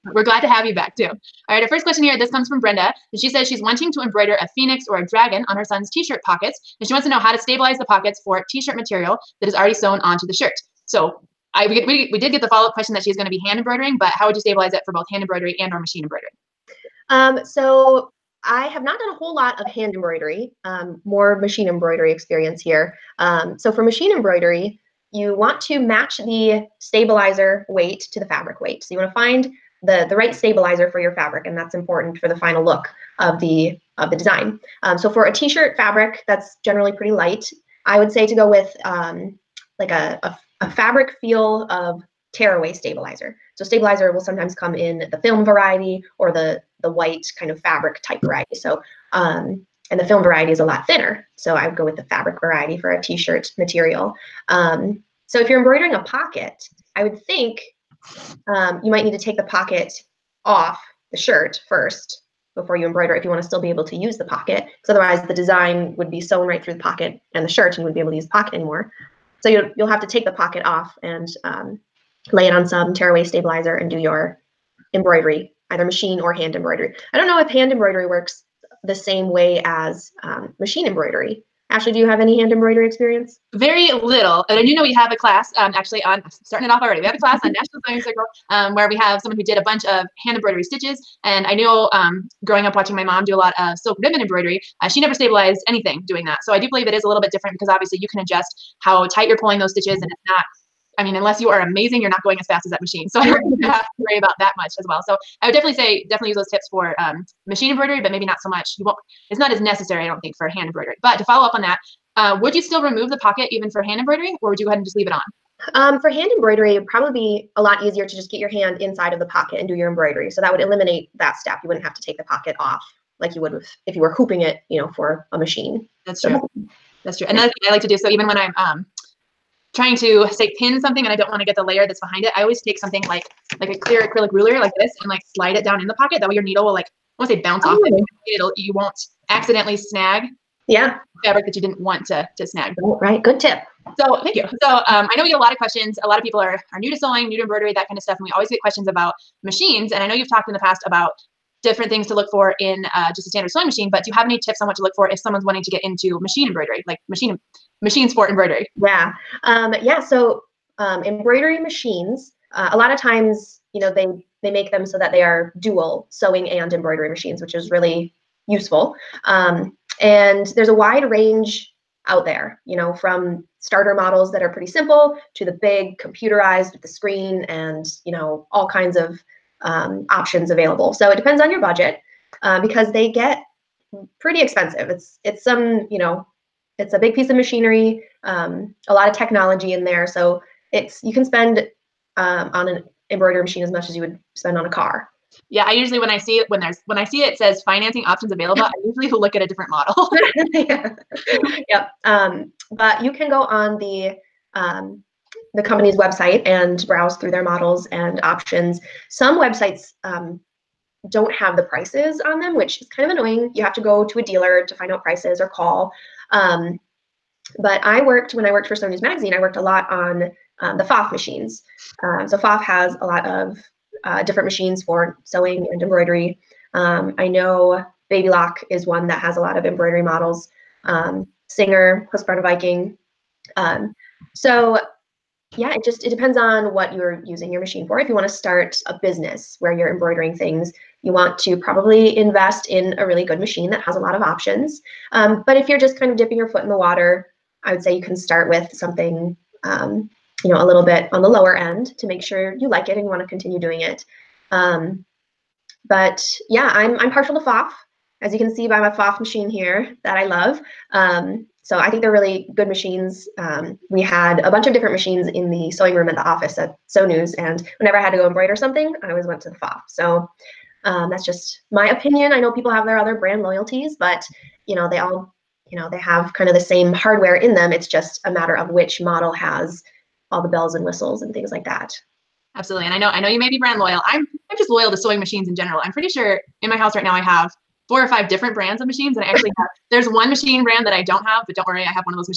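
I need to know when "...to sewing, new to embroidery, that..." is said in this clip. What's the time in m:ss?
2:26.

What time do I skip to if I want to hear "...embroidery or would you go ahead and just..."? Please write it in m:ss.
1:53.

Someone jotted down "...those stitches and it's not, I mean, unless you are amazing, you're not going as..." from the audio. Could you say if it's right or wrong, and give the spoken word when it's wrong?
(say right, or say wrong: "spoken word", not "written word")
right.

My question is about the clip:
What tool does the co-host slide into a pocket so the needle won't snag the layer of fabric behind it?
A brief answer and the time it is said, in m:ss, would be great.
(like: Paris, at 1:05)
Clear acrylic ruler, at 2:13.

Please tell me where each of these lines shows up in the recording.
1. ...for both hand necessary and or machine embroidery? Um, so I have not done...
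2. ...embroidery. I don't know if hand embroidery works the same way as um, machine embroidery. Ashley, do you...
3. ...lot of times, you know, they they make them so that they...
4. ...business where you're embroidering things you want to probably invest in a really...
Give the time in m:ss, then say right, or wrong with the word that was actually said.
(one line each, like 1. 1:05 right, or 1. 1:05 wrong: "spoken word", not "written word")
1. 0:14 wrong: "embroidery", not "necessary"
2. 1:16 right
3. 2:42 right
4. 3:59 right.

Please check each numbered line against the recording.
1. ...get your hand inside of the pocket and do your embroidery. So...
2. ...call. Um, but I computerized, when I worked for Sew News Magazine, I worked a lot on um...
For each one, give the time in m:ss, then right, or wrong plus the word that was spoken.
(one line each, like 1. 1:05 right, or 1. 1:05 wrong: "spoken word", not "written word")
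1. 1:58 right
2. 3:35 wrong: "worked", not "computerized".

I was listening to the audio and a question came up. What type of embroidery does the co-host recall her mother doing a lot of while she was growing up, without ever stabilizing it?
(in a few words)
Silk ribbon embroidery.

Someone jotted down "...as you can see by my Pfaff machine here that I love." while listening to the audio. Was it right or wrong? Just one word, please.
right.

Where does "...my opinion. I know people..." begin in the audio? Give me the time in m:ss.
4:31.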